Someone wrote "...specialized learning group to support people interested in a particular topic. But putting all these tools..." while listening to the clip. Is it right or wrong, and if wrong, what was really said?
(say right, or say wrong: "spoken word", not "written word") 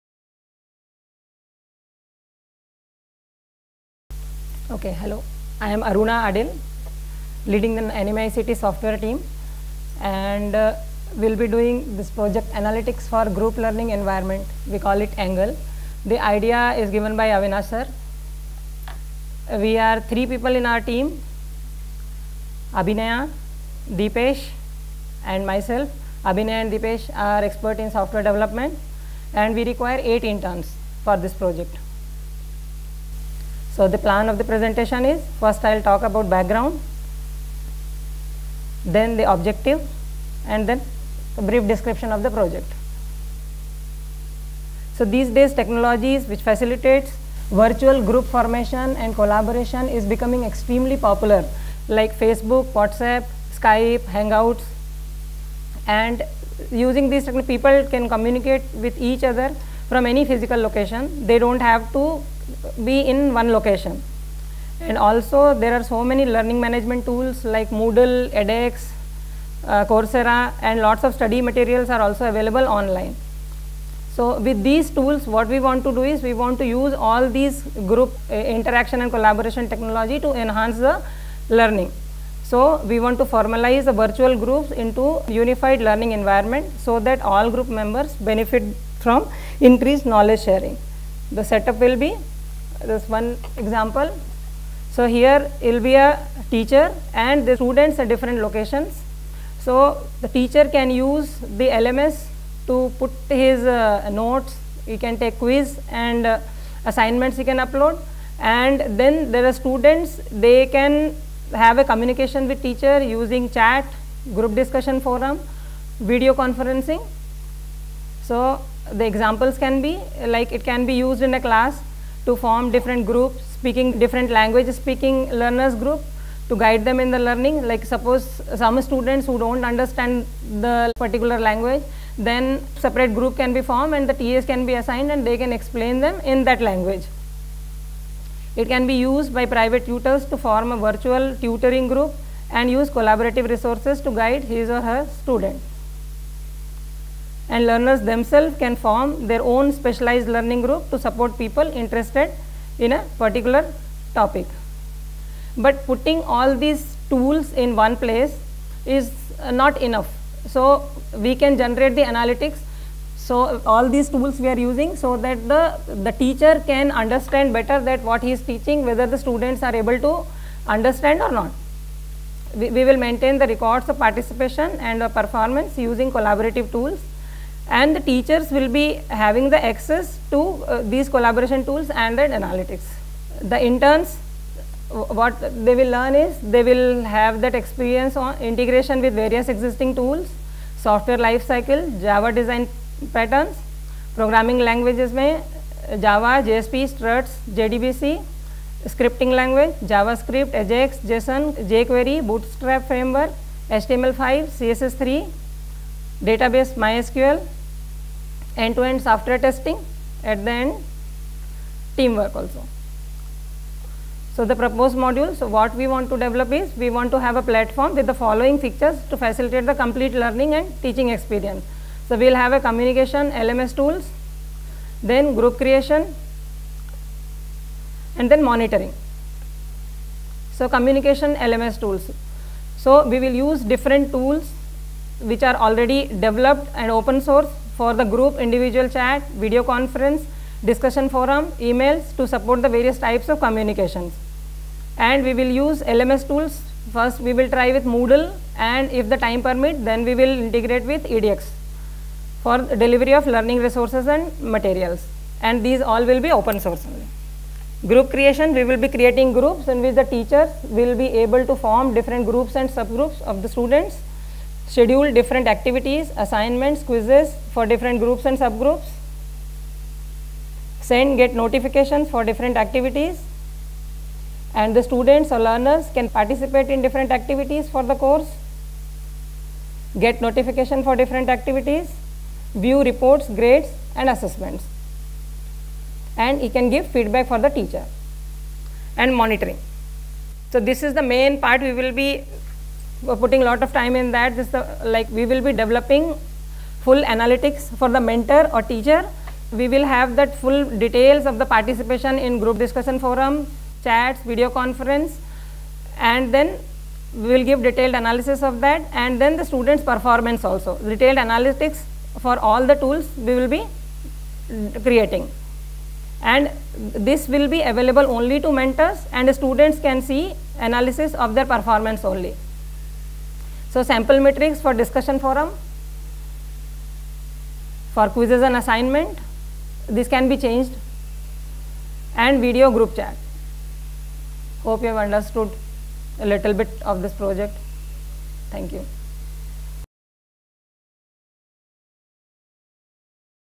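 right.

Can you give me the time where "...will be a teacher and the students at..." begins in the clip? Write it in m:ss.
1:35.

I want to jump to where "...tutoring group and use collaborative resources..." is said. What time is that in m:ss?
2:21.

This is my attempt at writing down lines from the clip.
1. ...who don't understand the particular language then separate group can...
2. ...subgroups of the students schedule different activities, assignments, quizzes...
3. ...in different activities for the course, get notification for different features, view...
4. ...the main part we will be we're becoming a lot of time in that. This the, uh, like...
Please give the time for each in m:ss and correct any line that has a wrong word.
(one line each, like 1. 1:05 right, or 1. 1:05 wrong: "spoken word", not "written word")
1. 2:09 right
2. 4:22 right
3. 4:36 wrong: "activities", not "features"
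4. 4:50 wrong: "putting", not "becoming".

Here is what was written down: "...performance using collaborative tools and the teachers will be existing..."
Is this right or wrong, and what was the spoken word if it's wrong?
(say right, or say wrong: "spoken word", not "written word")
wrong: "having", not "existing".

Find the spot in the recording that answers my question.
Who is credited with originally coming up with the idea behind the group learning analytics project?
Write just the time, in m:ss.
0:17.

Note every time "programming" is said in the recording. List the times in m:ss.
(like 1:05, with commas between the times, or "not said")
3:14.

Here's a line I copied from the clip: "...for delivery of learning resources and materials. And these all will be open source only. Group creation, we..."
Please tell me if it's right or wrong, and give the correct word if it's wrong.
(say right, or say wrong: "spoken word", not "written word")
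right.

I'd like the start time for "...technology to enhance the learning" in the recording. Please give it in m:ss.
1:19.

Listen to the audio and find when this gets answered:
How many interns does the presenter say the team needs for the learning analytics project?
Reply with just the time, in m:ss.
0:30.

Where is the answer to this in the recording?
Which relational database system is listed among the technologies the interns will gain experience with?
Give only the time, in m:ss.
3:26.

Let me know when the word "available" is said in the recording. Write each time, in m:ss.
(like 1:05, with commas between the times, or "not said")
1:12, 5:17.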